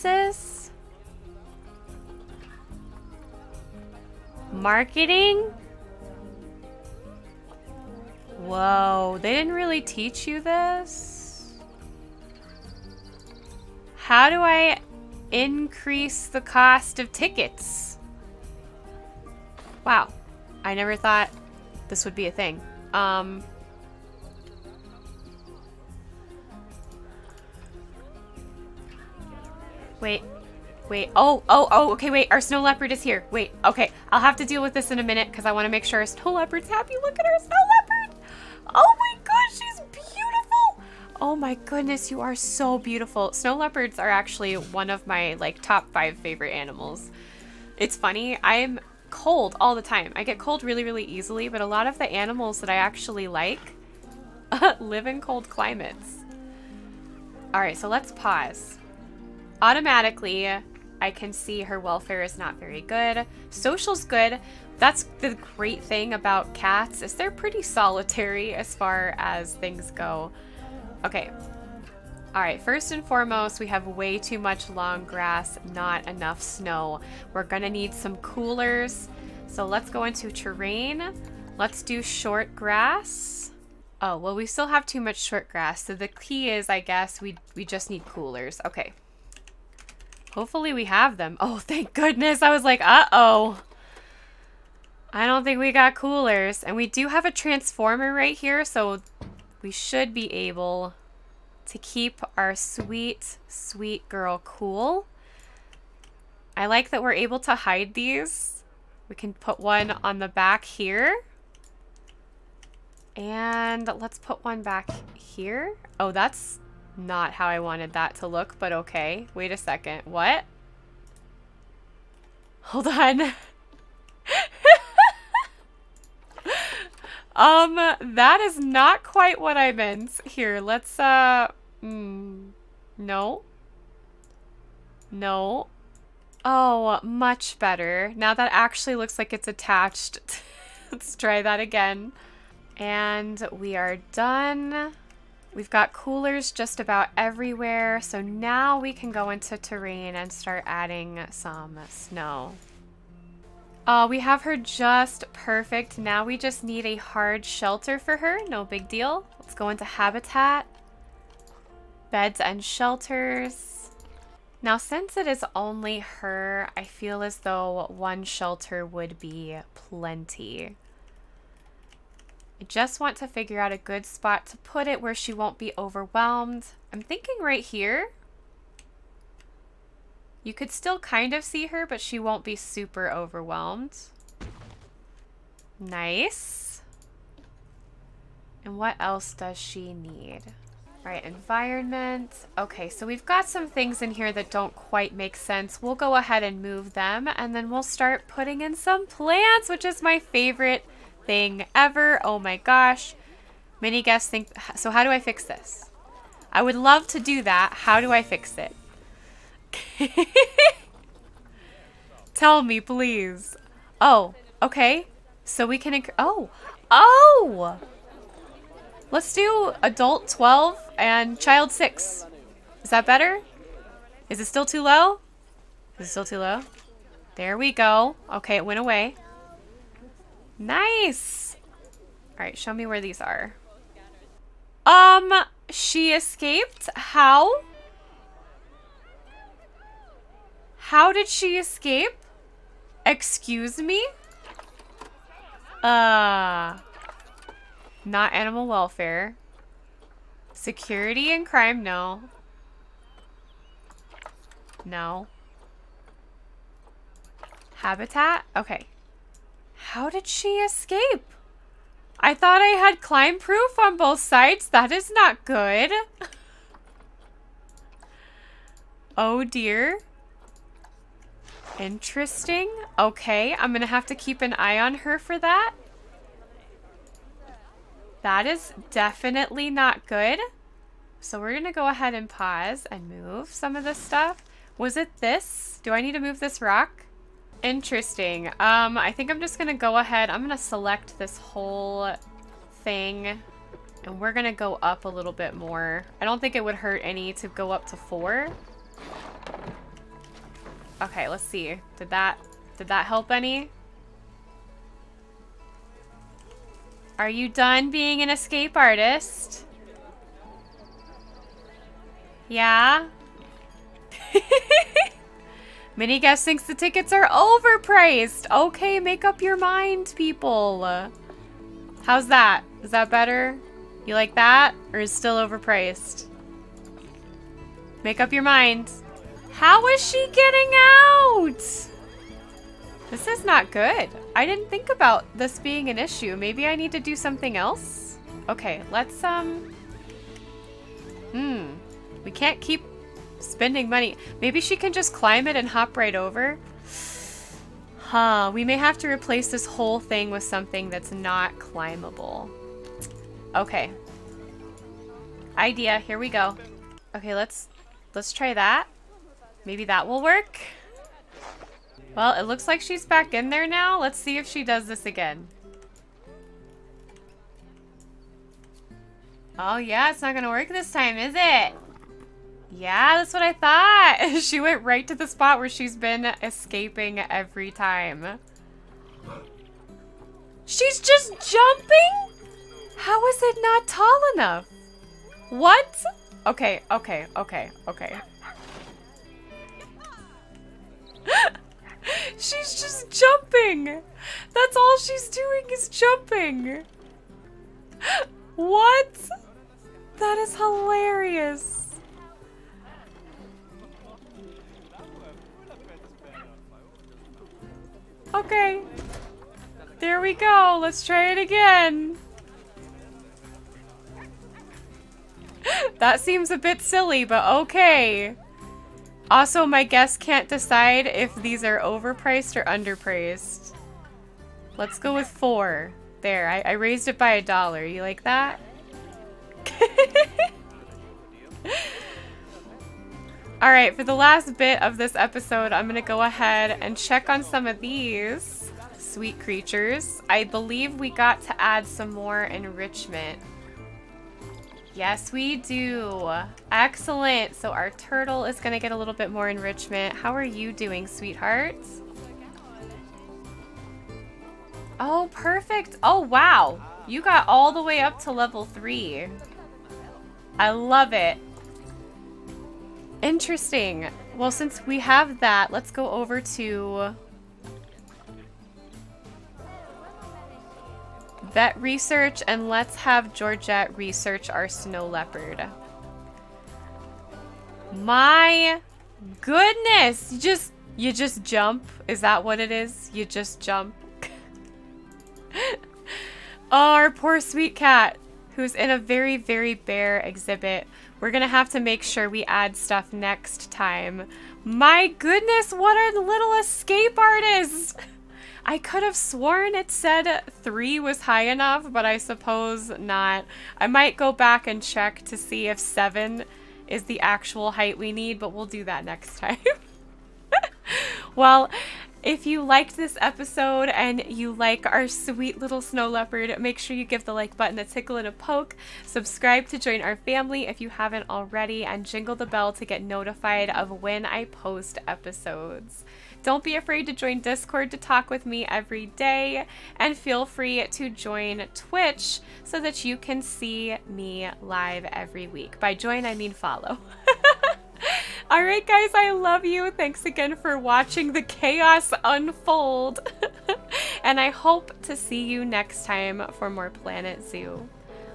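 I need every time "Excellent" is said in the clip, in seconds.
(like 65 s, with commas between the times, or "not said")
446 s.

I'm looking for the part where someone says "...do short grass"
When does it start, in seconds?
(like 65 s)
81 s.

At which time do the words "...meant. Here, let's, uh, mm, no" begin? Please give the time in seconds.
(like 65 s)
129 s.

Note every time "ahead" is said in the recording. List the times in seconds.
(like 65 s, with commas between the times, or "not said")
196 s, 281 s, 289 s, 436 s.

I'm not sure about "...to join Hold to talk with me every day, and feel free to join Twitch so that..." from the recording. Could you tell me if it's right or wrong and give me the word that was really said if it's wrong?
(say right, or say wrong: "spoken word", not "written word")
wrong: "Discord", not "Hold".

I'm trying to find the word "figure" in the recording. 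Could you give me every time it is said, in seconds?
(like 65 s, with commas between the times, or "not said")
173 s.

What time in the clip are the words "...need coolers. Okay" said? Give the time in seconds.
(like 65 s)
87 s.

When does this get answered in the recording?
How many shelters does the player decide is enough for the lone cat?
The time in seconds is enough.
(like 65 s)
167 s.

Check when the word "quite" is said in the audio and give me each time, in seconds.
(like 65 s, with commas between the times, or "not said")
129 s, 194 s.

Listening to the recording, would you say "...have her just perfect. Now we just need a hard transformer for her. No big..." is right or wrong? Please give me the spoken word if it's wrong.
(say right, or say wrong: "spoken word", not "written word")
wrong: "shelter", not "transformer".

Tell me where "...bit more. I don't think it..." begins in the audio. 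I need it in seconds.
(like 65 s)
295 s.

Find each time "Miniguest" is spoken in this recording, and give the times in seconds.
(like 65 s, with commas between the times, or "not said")
315 s.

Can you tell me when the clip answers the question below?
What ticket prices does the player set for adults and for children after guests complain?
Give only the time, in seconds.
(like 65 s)
219 s.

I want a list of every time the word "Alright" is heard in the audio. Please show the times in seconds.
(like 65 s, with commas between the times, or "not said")
232 s, 538 s.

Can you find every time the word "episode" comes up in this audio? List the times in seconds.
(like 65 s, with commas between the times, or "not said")
435 s, 513 s, 525 s.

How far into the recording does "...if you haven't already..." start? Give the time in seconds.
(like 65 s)
520 s.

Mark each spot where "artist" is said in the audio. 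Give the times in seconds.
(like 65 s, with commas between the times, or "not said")
308 s, 497 s.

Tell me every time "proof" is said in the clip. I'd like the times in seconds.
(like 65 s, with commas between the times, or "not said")
263 s.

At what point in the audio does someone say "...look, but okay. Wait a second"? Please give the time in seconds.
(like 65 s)
118 s.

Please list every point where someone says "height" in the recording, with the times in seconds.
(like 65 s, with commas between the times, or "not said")
507 s.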